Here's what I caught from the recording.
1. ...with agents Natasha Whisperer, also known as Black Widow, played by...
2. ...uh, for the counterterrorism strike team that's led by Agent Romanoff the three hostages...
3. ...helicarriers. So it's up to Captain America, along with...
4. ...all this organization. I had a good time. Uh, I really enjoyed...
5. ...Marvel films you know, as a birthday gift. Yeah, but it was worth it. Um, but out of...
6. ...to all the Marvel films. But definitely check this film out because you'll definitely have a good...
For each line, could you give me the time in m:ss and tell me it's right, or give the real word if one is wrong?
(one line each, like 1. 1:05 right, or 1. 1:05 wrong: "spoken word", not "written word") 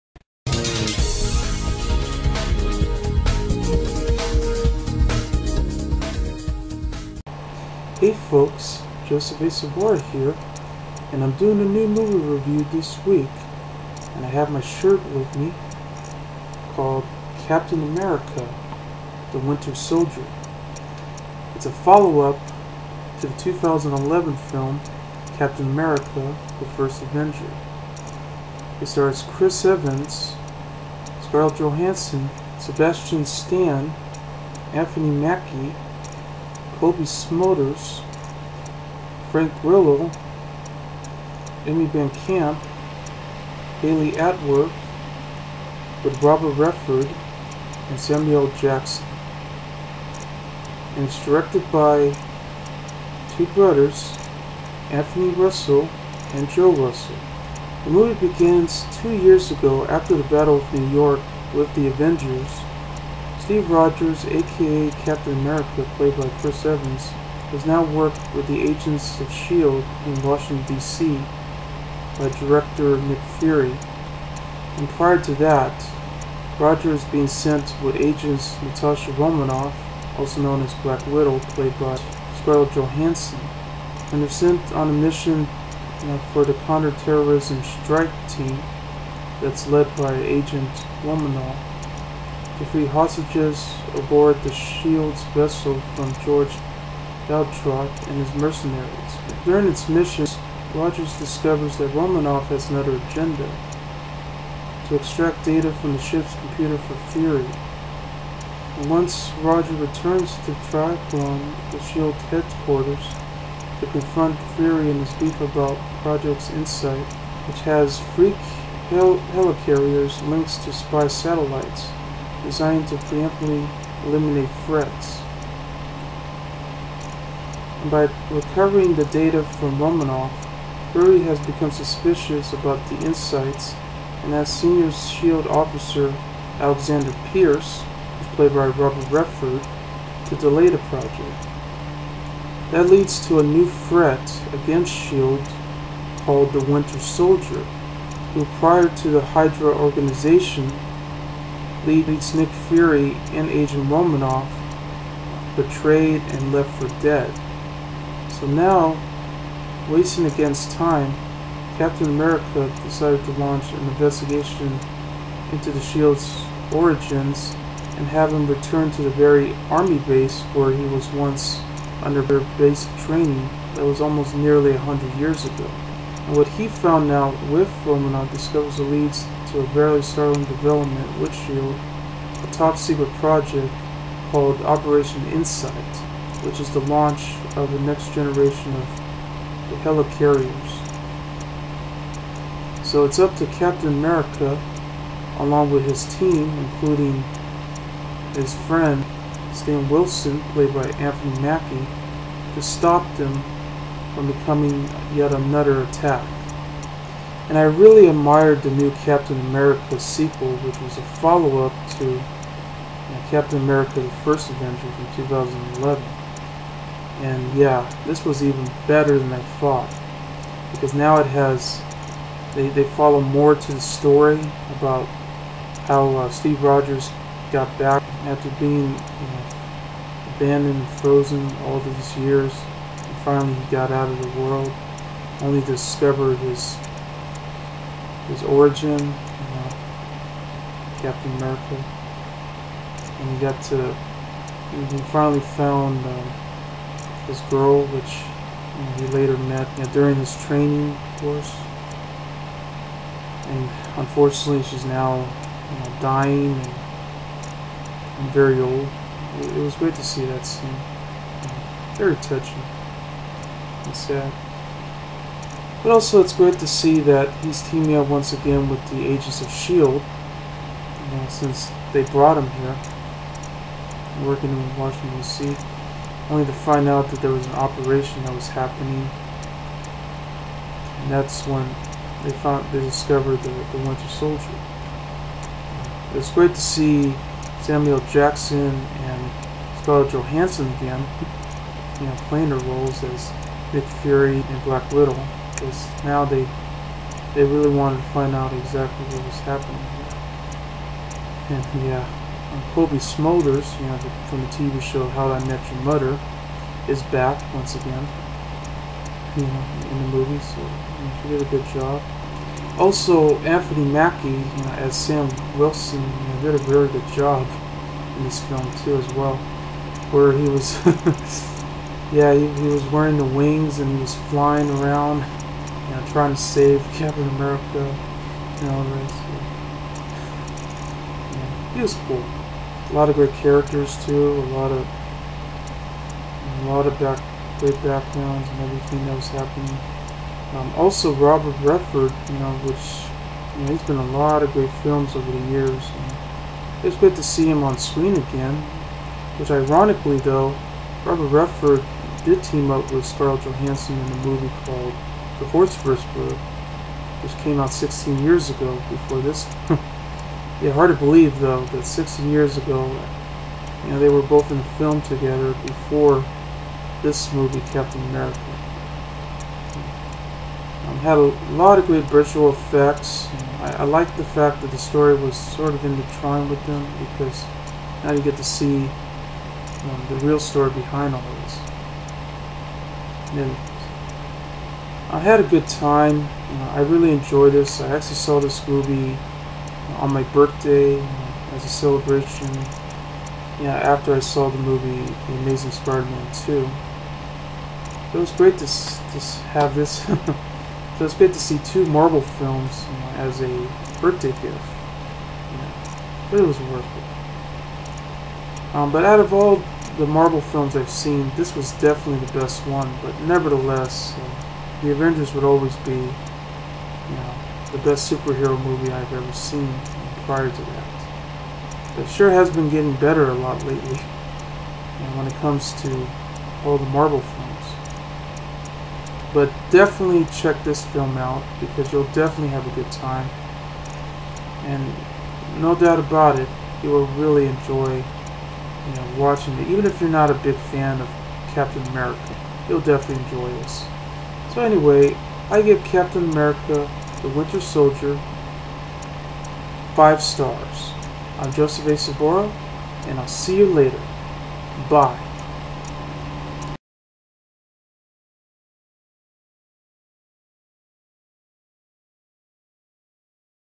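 1. 1:17 wrong: "Romanoff", not "Whisperer"
2. 1:25 right
3. 3:09 right
4. 6:21 wrong: "afternoon", not "organization"
5. 6:41 right
6. 7:05 right.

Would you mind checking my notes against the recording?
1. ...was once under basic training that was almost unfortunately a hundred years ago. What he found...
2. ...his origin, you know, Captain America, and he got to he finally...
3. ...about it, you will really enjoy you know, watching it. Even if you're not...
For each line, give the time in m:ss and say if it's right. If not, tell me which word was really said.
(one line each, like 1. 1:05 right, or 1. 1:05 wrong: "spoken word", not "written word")
1. 2:50 wrong: "nearly", not "unfortunately"
2. 3:58 right
3. 7:15 right.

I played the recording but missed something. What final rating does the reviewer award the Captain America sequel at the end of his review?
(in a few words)
5 stars.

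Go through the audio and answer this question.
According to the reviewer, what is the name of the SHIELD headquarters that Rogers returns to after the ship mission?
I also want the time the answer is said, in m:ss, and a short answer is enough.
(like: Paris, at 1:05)
Triclone, at 1:50.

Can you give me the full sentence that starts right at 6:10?
Um, had a lot of good visual effects.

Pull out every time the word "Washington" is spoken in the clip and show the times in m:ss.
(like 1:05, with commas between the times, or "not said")
1:10, 4:34.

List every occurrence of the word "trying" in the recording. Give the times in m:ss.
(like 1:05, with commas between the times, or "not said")
5:26, 6:16.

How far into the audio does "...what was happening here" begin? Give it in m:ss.
4:59.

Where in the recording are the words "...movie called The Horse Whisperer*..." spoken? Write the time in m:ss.
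5:54.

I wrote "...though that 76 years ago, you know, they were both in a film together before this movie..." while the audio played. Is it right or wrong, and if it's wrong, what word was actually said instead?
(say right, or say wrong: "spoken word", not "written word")
wrong: "16", not "76".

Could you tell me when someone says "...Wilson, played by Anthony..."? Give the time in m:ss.
3:19.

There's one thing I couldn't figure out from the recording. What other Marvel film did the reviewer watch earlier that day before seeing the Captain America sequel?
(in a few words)
The Amazing Spider-Man 2.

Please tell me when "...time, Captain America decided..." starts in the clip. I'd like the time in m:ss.
2:40.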